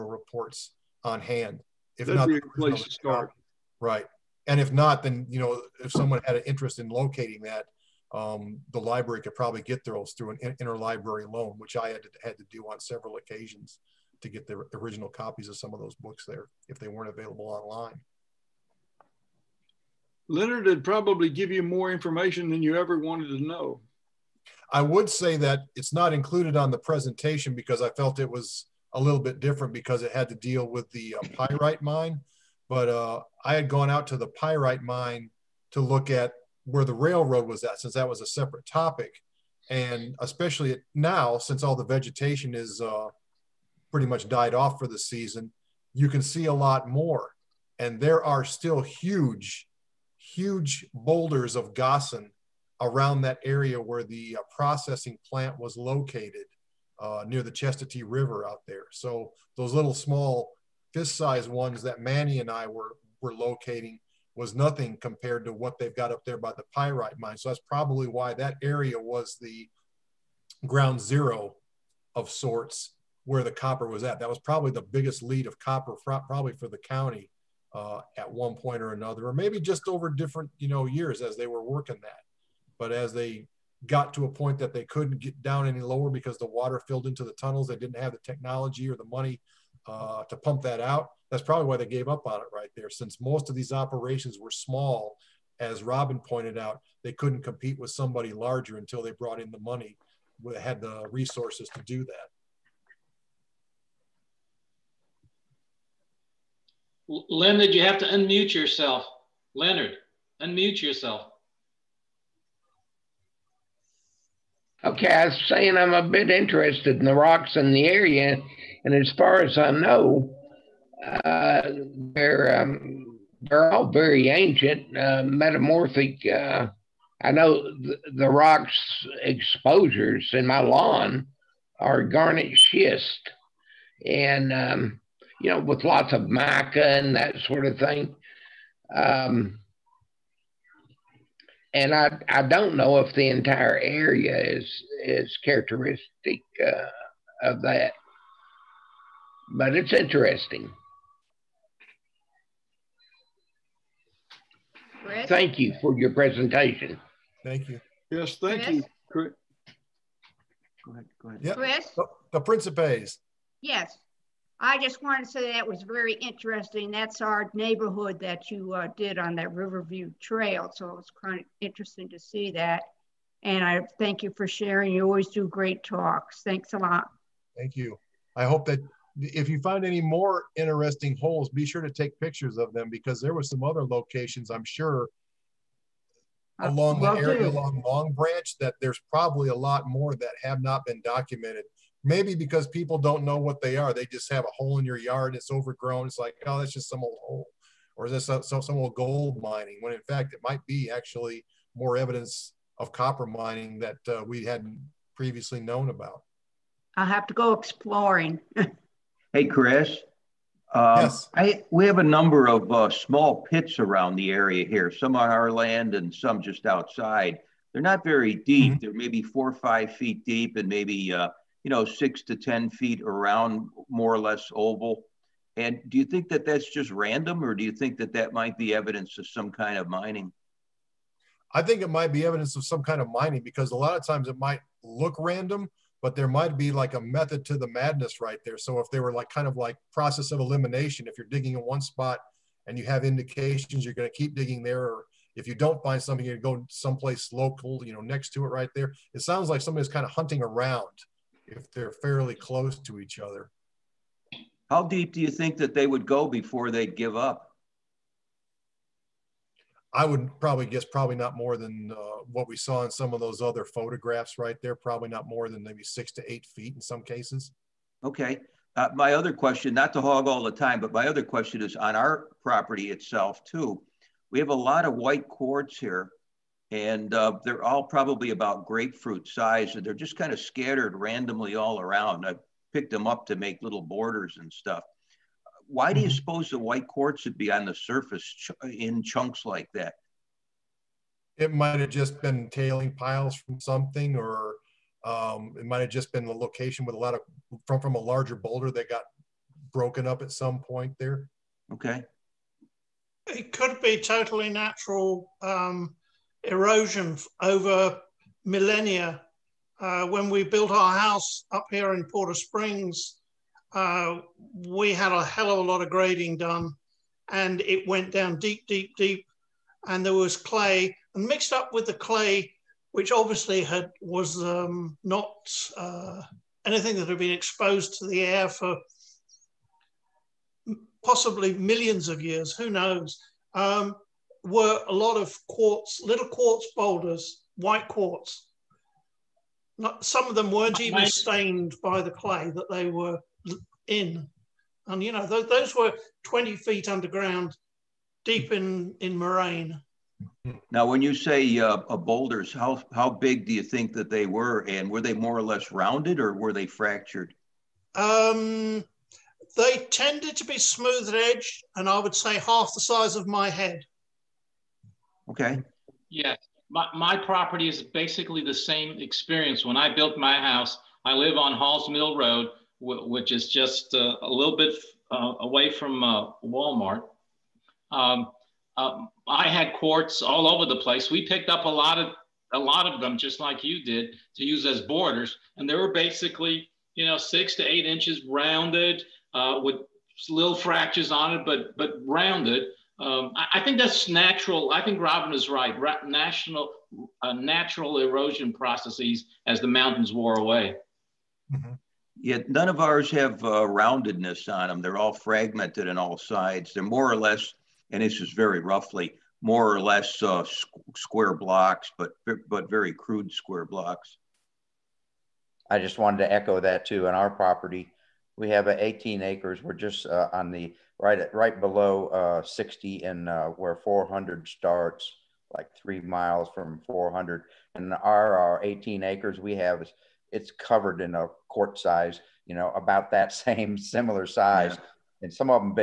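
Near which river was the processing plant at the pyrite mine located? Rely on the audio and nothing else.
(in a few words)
Chestatee River.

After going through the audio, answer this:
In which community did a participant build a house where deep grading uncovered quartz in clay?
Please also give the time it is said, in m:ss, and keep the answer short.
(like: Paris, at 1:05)
Porter Springs, at 5:12.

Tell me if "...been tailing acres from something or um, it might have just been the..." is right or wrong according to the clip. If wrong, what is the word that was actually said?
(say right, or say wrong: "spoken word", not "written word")
wrong: "piles", not "acres".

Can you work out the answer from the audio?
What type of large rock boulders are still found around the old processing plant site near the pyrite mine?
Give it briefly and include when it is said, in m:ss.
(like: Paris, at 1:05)
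Gossan, at 0:51.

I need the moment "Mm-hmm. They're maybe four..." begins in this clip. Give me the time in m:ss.
3:38.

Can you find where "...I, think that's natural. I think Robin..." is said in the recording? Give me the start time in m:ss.
6:33.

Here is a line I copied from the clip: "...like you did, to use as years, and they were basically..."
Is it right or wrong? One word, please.
wrong.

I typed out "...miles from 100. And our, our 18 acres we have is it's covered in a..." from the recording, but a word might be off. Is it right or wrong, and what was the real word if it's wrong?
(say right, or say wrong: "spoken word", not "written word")
wrong: "400", not "100".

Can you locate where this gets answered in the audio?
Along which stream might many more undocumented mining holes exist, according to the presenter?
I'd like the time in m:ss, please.
3:07.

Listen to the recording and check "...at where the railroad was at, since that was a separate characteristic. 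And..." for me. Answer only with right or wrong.
wrong.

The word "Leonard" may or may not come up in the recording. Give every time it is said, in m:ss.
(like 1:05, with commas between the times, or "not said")
0:20, 1:49.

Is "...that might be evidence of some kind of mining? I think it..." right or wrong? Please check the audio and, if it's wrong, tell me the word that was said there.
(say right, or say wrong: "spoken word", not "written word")
right.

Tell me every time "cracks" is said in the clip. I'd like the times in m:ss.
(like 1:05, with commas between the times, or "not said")
not said.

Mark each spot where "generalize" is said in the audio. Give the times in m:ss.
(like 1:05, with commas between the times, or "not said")
not said.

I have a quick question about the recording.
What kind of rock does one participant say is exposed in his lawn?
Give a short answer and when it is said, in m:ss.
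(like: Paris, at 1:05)
Garnet schist, at 2:12.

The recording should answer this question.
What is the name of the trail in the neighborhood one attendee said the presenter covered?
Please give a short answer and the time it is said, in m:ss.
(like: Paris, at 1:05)
Riverview Trail, at 2:49.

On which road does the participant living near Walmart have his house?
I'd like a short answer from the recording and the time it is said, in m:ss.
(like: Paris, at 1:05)
Halls Mill Road, at 6:11.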